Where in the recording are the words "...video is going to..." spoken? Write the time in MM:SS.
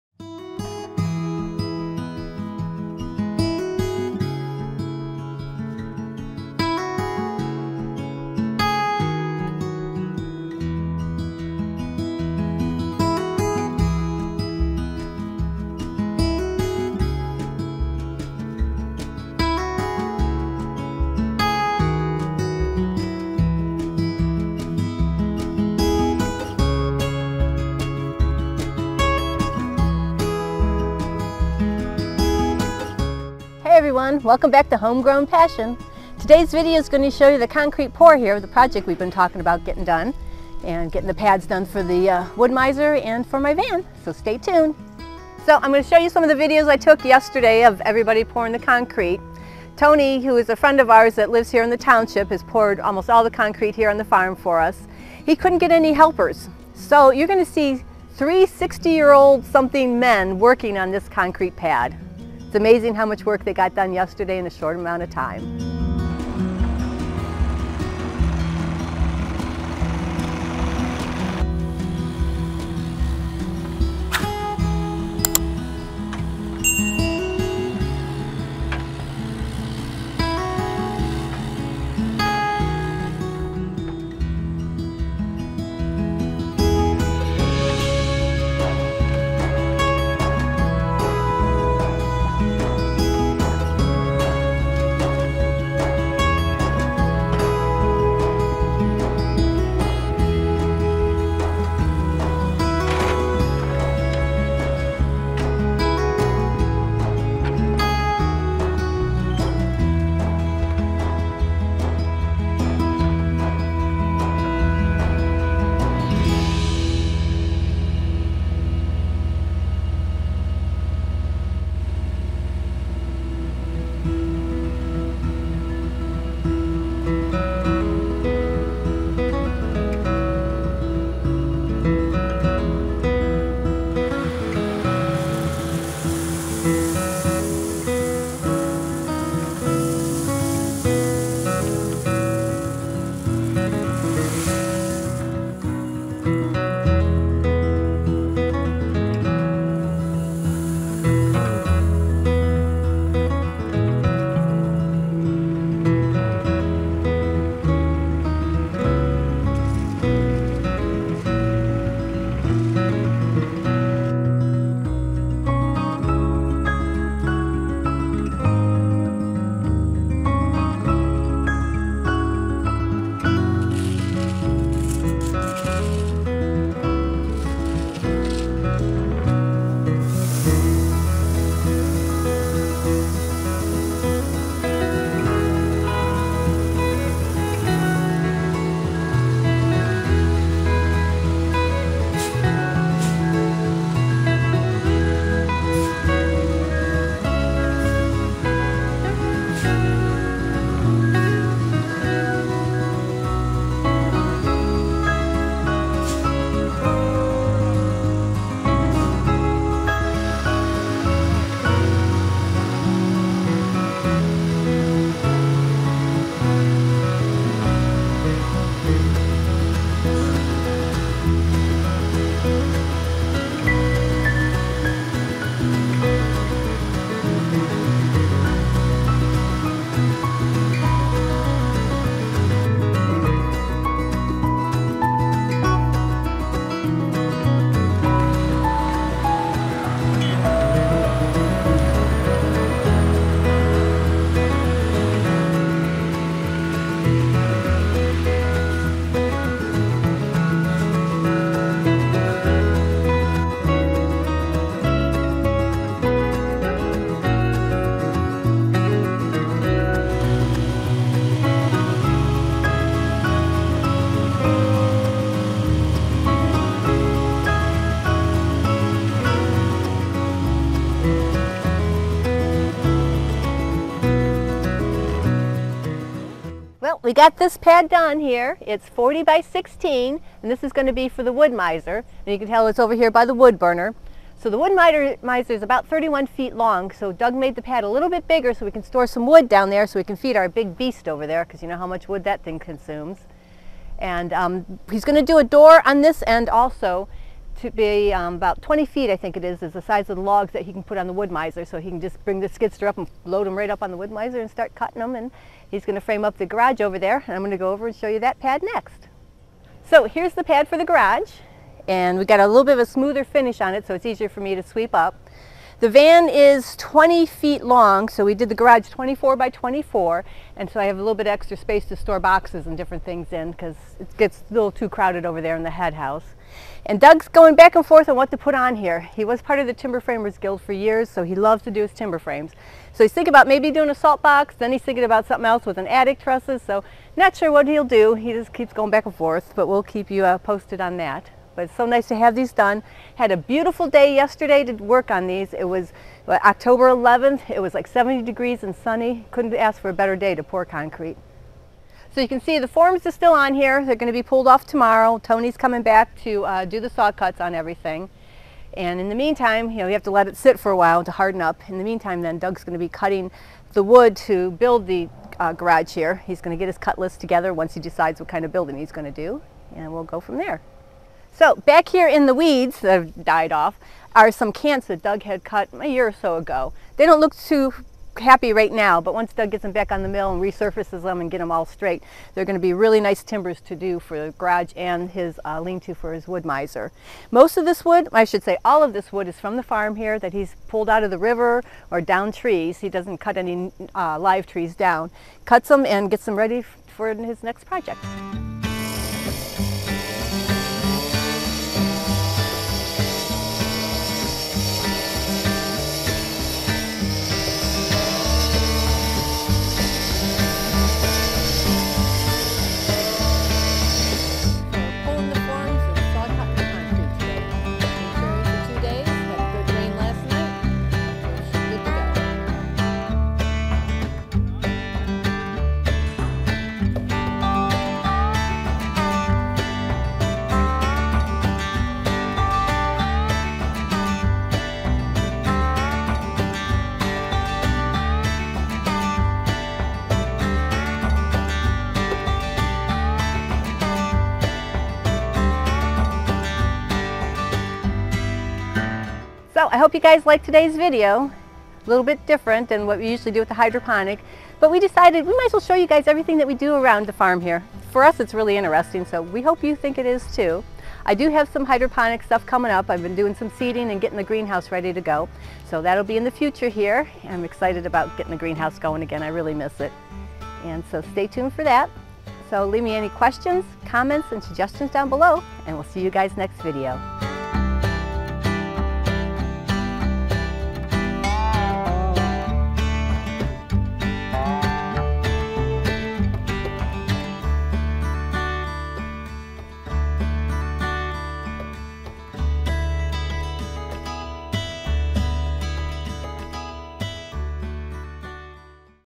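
00:36.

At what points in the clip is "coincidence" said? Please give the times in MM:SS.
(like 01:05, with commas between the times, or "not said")
not said.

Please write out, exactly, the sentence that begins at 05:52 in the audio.
So you can see the forms are still on here.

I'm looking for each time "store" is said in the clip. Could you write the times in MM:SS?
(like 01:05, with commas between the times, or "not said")
04:48, 05:21.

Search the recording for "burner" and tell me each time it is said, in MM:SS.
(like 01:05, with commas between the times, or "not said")
04:43.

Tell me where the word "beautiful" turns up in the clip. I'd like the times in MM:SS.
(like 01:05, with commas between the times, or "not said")
05:43.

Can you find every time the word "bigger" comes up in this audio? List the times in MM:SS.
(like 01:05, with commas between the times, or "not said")
04:48.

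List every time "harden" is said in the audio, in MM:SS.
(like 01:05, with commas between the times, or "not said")
06:01.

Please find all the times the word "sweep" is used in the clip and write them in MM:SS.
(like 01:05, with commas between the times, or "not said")
05:14.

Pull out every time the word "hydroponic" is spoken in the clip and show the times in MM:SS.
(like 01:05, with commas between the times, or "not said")
07:33, 07:41.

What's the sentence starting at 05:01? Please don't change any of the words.
So he can just bring the skidder up and load them right up on the Wood-Mizer and start cutting them.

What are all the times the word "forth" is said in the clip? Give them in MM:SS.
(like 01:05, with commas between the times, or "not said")
05:27, 05:39.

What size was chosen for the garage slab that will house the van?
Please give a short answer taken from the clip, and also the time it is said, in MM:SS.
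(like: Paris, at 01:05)
24 by 24, at 05:18.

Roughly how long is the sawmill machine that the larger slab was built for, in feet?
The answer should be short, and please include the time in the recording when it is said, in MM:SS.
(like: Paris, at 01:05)
31 feet, at 04:45.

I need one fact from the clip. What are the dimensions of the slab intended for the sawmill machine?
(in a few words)
40 by 16.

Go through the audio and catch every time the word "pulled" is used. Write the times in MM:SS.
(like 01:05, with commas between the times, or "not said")
05:54, 06:30.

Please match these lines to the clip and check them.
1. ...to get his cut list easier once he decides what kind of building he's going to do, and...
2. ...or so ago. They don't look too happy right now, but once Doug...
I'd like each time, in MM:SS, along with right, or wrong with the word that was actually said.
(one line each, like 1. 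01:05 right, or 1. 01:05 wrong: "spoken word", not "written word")
1. 06:06 wrong: "together", not "easier"
2. 06:16 right.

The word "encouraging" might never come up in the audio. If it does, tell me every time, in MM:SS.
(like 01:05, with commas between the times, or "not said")
not said.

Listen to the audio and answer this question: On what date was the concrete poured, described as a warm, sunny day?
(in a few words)
October 11th.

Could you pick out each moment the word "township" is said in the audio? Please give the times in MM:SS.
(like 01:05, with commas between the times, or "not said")
00:51.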